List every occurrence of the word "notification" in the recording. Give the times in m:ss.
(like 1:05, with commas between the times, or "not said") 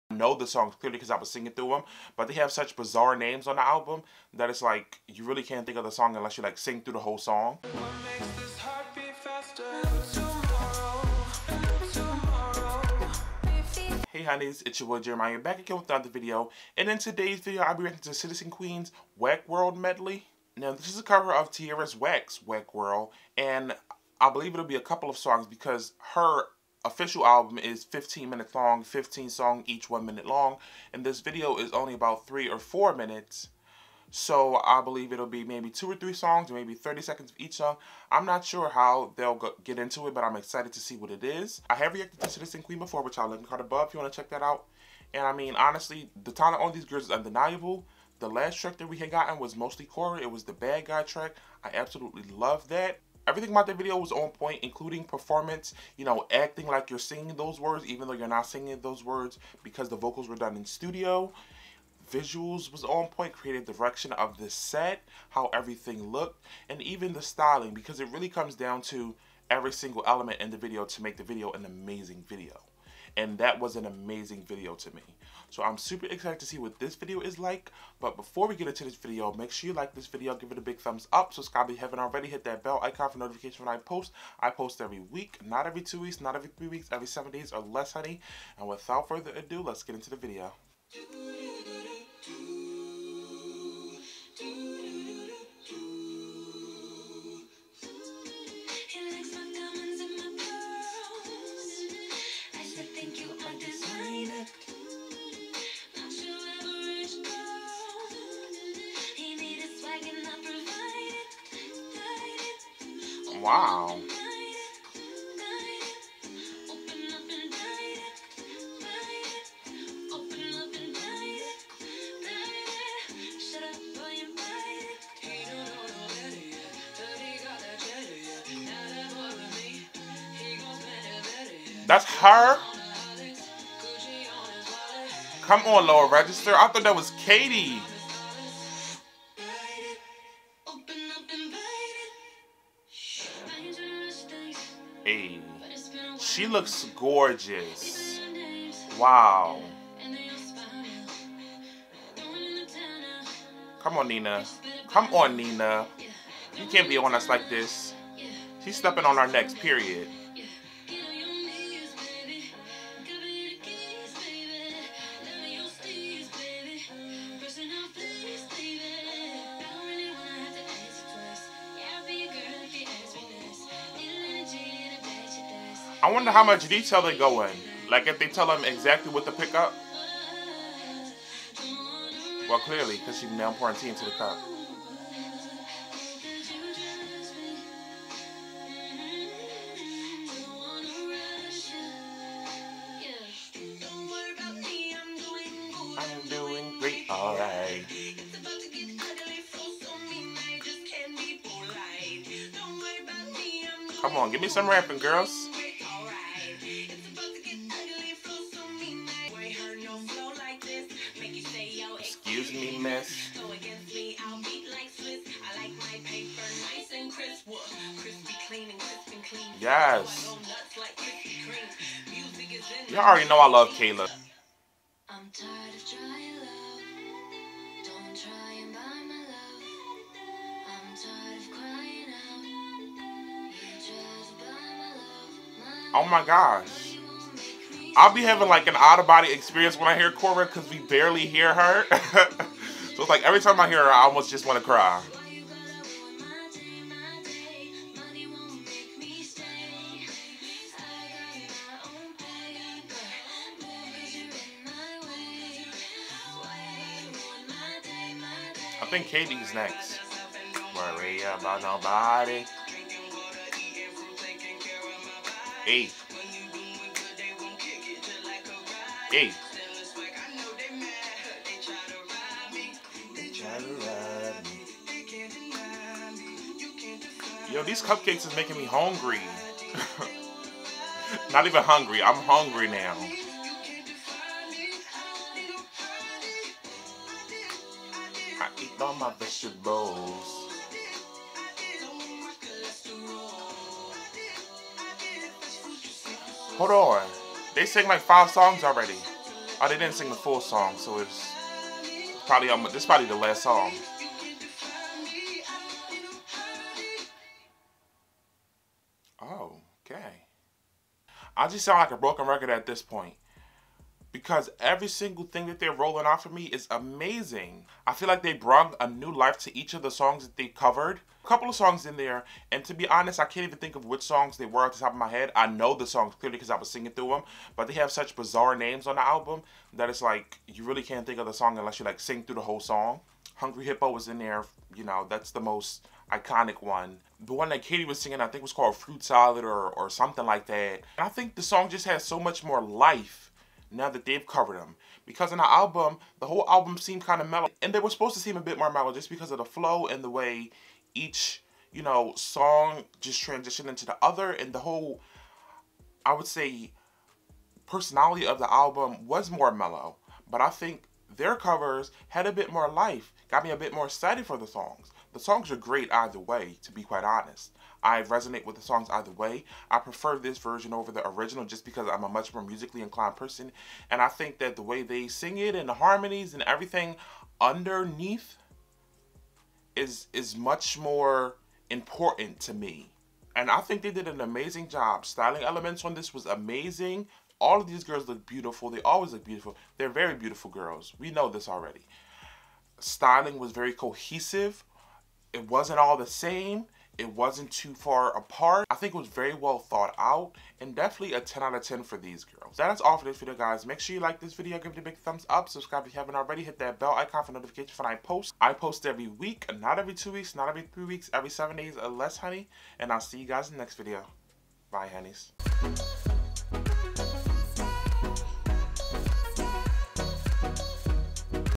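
1:23, 6:47.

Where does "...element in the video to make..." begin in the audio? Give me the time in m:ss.
1:10.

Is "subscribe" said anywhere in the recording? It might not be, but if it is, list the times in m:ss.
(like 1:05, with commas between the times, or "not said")
1:21, 6:45.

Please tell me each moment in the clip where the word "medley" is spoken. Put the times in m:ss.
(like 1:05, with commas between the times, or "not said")
0:19.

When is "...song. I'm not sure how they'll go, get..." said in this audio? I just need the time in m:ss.
0:37.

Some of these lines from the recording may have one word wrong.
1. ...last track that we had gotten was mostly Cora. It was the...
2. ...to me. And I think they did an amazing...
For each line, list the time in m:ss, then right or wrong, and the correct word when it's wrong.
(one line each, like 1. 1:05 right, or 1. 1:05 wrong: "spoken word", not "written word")
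1. 0:48 right
2. 6:22 right.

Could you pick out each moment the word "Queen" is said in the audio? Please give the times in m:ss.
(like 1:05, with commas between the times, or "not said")
0:18, 0:42.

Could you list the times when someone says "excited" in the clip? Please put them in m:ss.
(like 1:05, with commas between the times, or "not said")
0:40, 1:16, 6:03.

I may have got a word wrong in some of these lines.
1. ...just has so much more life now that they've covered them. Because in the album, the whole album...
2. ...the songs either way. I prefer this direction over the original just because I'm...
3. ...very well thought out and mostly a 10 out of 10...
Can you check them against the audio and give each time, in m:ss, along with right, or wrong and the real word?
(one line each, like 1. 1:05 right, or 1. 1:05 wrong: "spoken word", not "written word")
1. 5:41 right
2. 6:08 wrong: "version", not "direction"
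3. 6:39 wrong: "definitely", not "mostly".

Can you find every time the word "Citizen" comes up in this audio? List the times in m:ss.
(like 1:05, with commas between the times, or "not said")
0:18, 0:42.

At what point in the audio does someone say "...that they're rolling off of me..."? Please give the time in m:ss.
5:15.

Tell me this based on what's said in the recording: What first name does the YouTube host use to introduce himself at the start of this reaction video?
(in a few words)
Jeremiah.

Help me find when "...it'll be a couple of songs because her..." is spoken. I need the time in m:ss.
0:24.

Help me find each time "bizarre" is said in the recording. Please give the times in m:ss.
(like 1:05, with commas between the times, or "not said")
0:02, 5:28.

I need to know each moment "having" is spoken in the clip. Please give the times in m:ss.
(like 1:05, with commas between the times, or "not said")
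3:58.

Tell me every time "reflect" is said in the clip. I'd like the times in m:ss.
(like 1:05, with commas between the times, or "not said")
not said.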